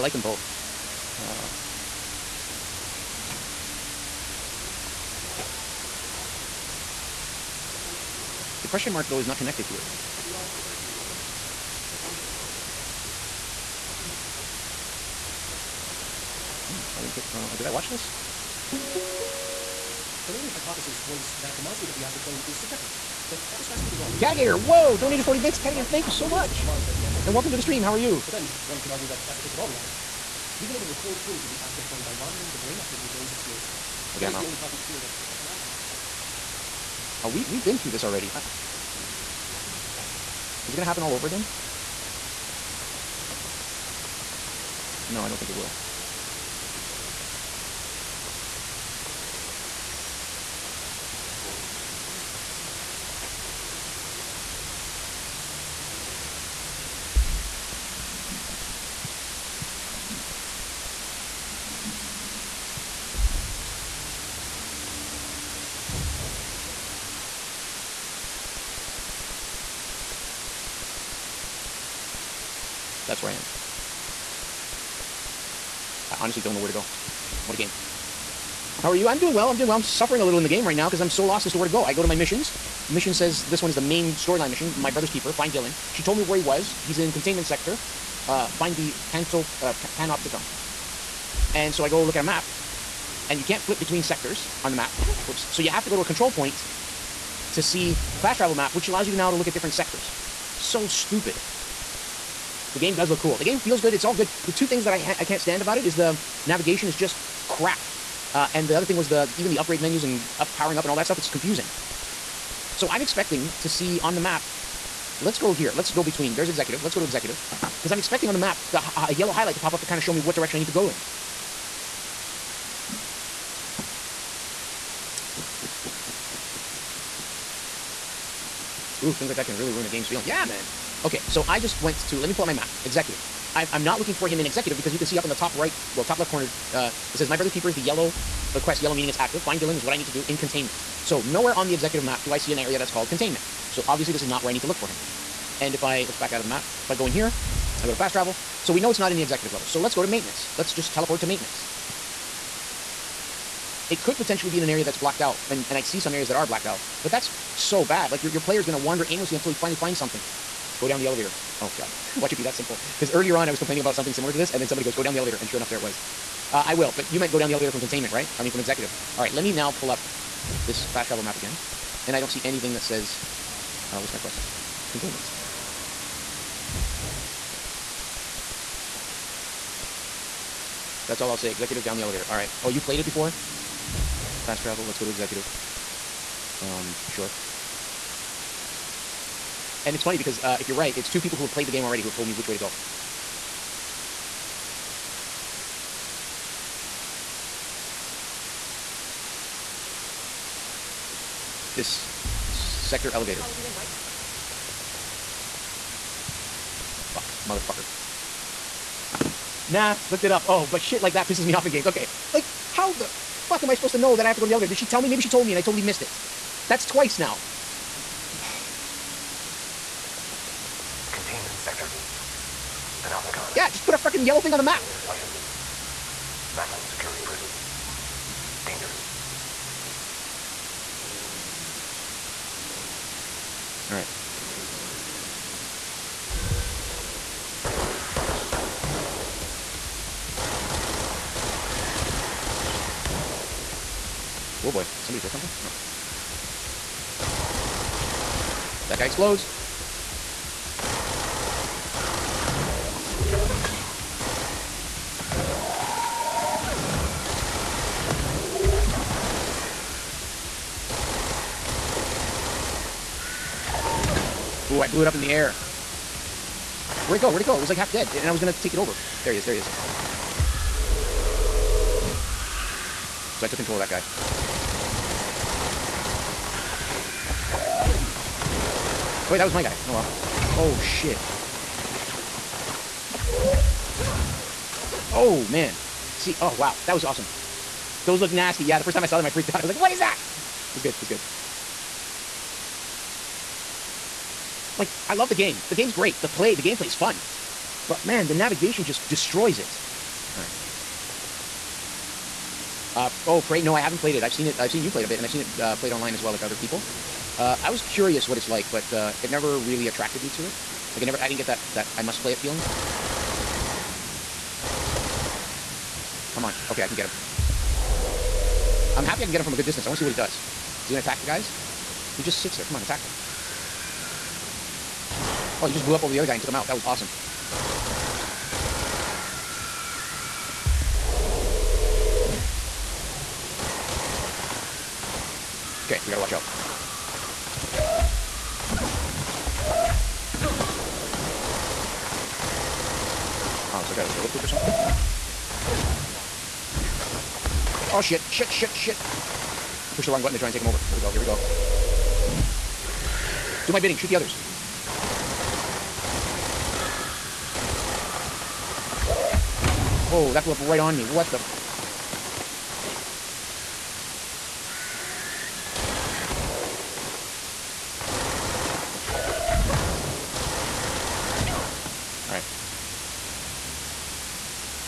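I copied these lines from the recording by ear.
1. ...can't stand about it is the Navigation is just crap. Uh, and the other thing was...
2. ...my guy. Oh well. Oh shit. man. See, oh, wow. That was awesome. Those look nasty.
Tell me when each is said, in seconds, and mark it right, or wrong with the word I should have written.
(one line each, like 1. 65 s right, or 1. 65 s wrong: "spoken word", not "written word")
1. 105 s right
2. 279 s right.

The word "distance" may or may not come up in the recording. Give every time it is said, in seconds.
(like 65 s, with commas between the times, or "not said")
319 s.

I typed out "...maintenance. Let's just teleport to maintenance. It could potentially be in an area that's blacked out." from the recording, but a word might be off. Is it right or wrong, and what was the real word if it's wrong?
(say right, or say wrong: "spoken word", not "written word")
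right.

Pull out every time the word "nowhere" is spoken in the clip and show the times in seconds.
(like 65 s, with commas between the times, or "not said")
141 s.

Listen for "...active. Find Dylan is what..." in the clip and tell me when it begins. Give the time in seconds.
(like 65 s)
139 s.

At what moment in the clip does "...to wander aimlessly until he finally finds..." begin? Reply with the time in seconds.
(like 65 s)
158 s.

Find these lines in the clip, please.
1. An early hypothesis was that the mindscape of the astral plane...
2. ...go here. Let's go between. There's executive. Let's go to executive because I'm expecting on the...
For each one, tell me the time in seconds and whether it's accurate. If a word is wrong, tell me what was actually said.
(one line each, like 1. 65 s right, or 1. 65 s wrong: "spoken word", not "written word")
1. 18 s right
2. 115 s right.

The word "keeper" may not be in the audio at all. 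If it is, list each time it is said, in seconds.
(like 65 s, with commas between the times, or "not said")
85 s, 137 s.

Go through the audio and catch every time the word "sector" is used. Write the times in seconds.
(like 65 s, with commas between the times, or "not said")
87 s, 94 s, 99 s, 202 s, 221 s.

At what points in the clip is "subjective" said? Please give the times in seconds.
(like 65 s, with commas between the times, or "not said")
22 s.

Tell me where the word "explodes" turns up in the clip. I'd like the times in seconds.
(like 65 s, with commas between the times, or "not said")
249 s.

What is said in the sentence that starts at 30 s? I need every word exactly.
We've been able to record footage of the astral plane by monitoring the brain activity of those experiencing it.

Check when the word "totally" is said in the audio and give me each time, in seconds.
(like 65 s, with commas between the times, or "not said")
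215 s.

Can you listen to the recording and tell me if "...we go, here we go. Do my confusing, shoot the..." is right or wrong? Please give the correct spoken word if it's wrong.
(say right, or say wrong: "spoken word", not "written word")
wrong: "bidding", not "confusing".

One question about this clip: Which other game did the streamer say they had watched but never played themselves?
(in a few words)
Prey.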